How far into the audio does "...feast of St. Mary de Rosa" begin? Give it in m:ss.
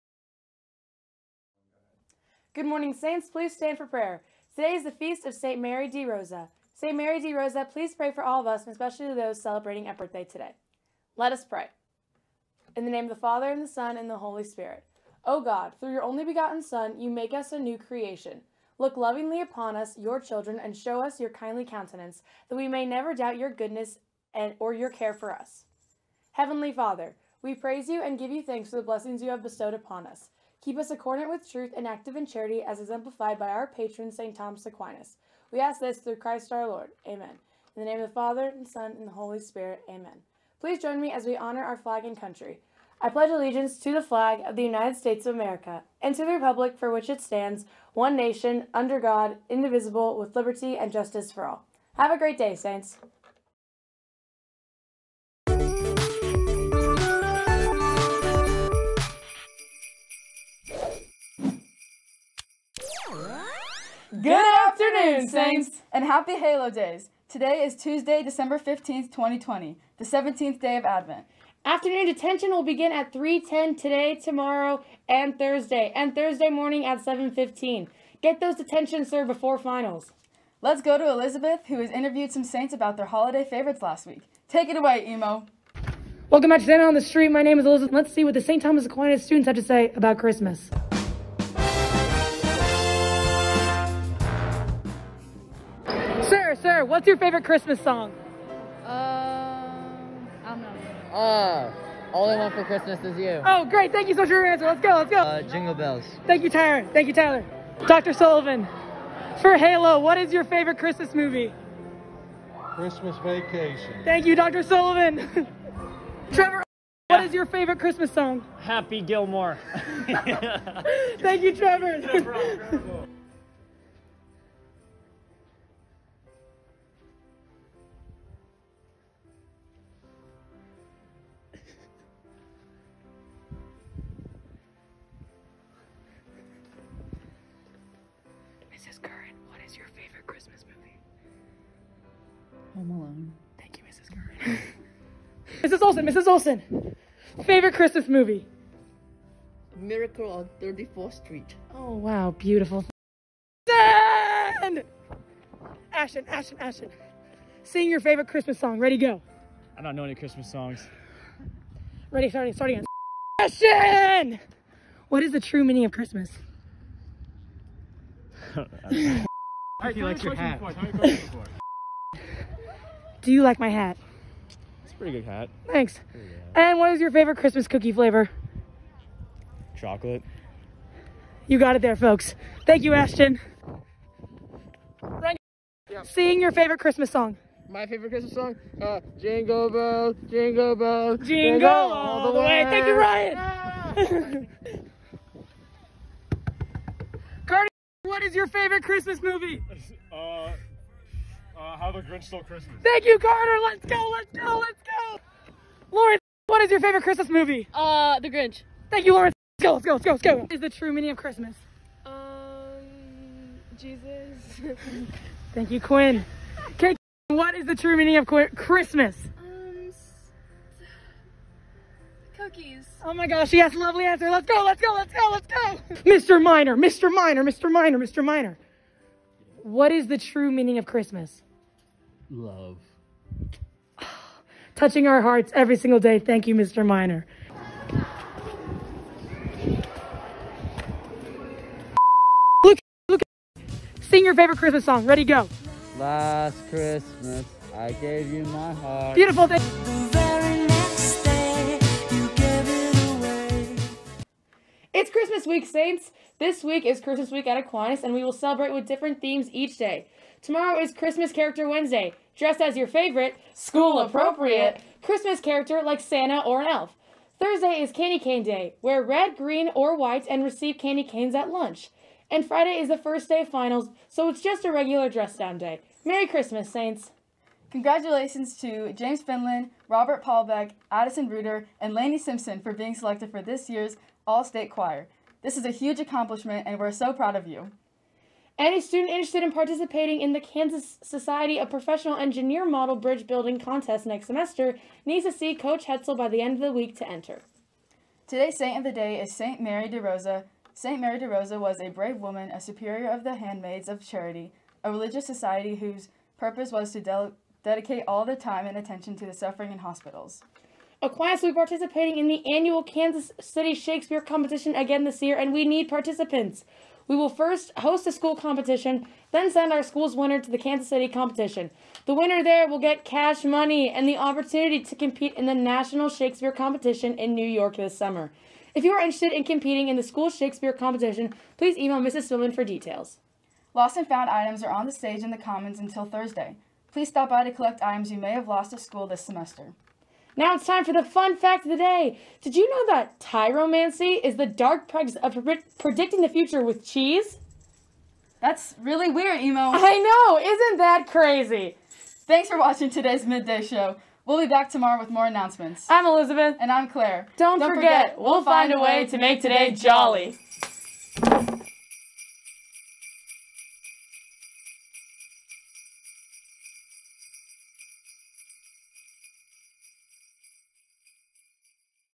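0:04.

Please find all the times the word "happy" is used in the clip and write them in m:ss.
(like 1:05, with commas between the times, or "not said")
1:06, 1:58.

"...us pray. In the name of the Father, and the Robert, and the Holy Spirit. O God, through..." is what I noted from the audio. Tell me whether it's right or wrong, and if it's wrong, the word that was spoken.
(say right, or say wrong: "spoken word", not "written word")
wrong: "Son", not "Robert".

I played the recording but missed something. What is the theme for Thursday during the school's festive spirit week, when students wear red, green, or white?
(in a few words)
Candy Cane Day.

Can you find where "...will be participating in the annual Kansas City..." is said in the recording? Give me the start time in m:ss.
5:11.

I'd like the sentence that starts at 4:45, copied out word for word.
This is a huge accomplishment, and we're so proud of you.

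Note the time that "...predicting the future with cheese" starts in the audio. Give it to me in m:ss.
5:45.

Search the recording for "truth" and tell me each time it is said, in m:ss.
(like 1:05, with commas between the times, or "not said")
0:31.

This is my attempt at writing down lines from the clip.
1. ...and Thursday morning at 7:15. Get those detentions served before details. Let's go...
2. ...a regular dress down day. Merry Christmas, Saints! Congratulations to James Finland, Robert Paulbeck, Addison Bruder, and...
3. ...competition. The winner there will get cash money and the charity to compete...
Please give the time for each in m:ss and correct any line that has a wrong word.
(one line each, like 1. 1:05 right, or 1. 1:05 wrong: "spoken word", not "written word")
1. 1:15 wrong: "finals", not "details"
2. 4:34 right
3. 5:21 wrong: "opportunity", not "charity".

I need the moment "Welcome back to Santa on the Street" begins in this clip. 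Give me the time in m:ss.
1:26.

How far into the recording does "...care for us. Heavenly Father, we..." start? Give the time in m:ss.
0:24.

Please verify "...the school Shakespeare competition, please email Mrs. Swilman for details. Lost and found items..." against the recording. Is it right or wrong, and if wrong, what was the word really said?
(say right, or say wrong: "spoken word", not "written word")
right.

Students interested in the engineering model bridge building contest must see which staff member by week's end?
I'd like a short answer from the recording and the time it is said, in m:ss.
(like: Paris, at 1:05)
Coach Hetzel, at 4:55.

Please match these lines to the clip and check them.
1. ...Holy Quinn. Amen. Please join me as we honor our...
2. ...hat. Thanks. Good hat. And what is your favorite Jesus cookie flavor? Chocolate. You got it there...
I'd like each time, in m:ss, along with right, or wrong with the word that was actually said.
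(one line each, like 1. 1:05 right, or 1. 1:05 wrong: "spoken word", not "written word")
1. 0:39 wrong: "Spirit", not "Quinn"
2. 2:55 wrong: "Christmas", not "Jesus".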